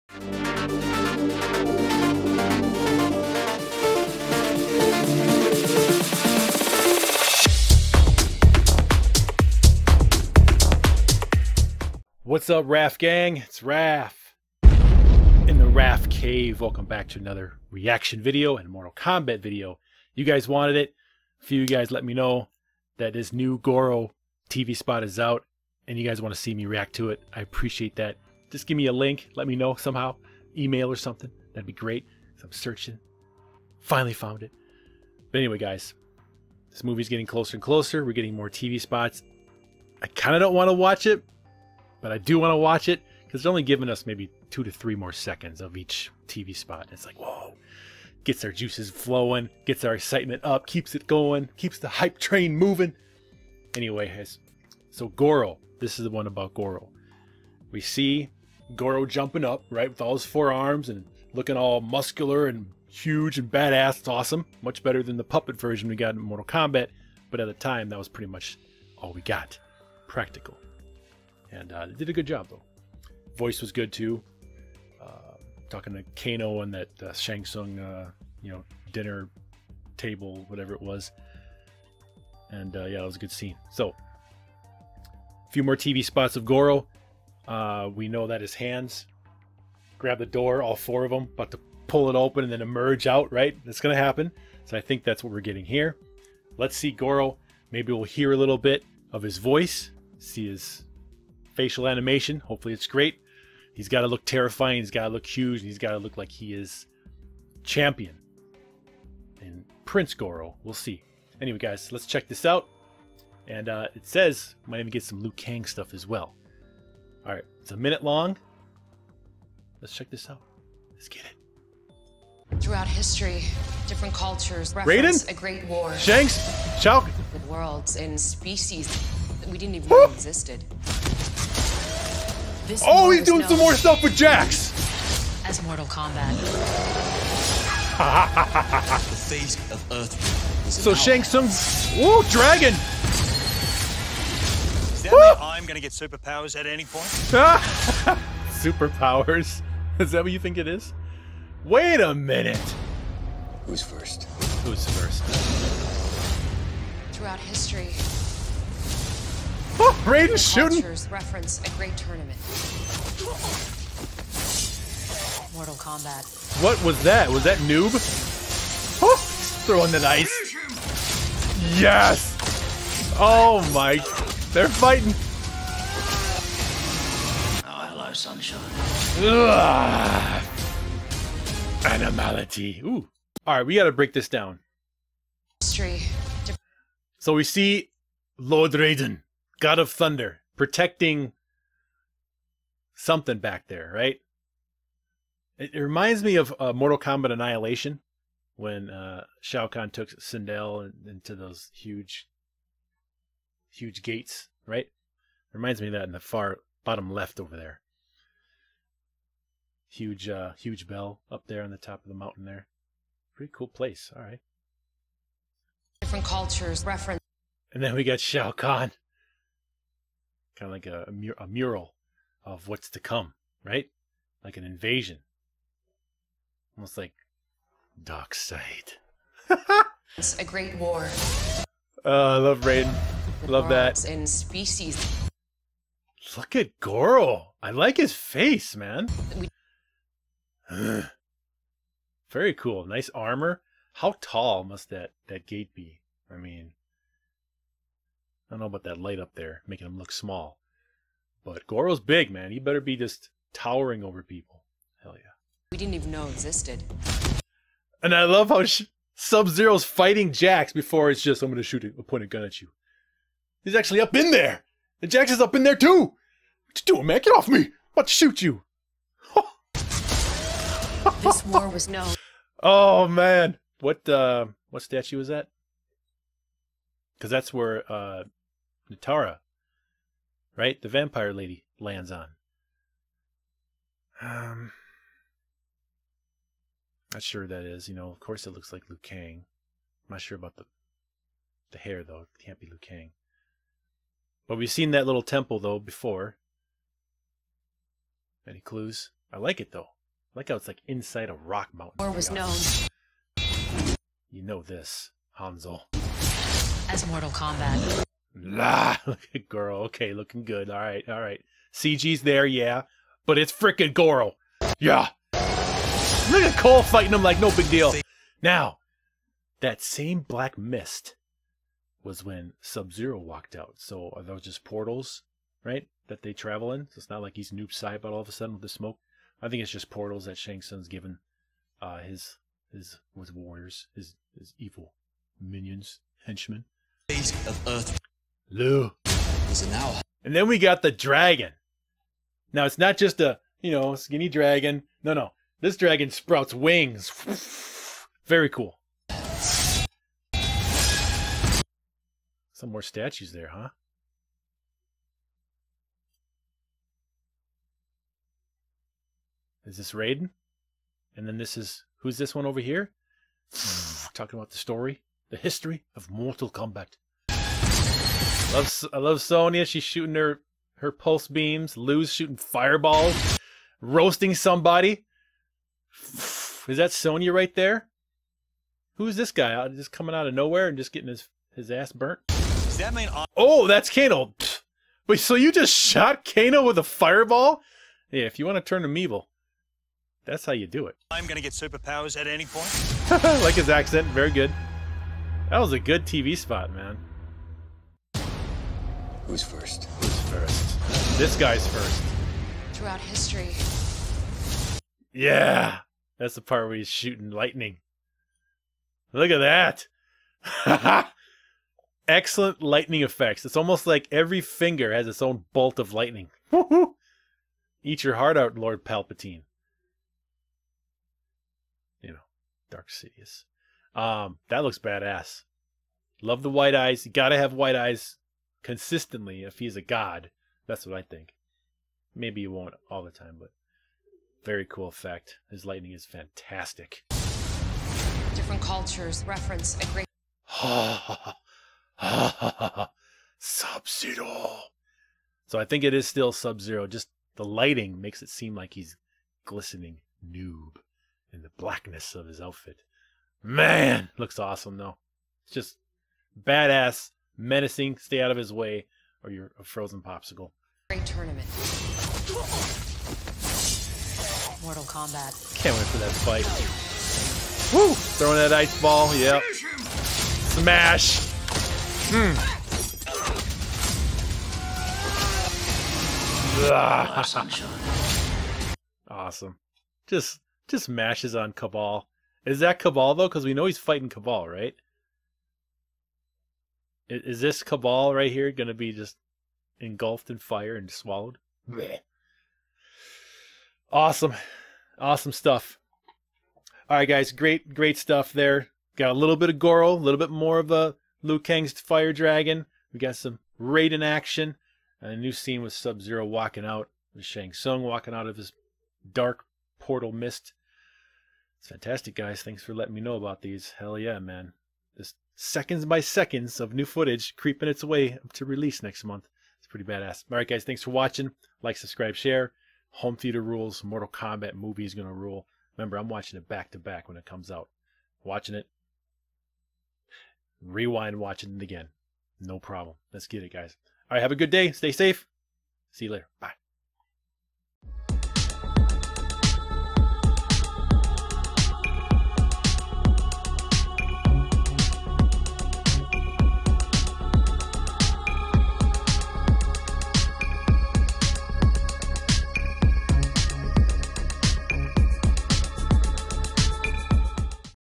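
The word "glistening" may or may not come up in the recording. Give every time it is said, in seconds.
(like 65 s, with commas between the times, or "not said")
449 s.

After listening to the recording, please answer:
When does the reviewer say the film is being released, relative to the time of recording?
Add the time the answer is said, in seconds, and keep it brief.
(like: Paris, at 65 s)
next month, at 518 s.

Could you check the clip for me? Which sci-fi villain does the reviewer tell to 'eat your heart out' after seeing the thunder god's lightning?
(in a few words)
Lord Palpatine.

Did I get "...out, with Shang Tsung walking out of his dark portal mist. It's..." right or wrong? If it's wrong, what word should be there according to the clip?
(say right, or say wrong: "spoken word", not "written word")
right.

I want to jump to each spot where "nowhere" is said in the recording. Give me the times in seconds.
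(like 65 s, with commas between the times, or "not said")
380 s.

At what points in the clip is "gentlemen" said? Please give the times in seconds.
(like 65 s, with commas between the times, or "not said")
not said.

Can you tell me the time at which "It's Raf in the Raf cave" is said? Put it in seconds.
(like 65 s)
13 s.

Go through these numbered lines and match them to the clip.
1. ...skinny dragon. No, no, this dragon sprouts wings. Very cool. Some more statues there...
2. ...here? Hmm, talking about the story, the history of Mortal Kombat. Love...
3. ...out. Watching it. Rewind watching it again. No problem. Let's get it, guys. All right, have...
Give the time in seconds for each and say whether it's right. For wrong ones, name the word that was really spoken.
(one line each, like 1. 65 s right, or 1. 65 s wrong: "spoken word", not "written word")
1. 343 s right
2. 362 s right
3. 527 s right.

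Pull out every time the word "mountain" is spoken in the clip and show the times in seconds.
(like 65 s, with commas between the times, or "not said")
212 s, 301 s.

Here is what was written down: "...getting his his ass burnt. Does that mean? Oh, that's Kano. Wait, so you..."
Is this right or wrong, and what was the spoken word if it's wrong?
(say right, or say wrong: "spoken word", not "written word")
right.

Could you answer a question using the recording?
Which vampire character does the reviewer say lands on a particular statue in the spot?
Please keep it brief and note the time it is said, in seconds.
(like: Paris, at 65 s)
Nitara, at 278 s.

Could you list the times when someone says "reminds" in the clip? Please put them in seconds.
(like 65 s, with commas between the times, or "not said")
195 s, 205 s.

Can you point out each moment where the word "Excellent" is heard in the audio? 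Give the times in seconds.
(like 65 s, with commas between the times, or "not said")
412 s.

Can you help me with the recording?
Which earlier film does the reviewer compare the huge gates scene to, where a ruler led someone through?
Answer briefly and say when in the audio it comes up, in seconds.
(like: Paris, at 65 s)
Mortal Kombat Annihilation, at 196 s.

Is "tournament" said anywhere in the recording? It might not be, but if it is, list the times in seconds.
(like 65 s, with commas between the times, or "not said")
161 s, 461 s.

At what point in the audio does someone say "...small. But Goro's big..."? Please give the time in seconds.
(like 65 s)
250 s.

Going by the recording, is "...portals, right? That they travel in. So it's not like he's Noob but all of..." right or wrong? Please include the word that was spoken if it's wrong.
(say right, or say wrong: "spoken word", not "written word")
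right.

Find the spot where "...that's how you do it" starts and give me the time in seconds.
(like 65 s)
390 s.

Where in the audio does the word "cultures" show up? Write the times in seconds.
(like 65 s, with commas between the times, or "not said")
124 s, 216 s, 438 s.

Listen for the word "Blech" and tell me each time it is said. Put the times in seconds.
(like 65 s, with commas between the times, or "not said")
491 s.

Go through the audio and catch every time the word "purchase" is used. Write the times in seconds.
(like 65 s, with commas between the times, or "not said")
not said.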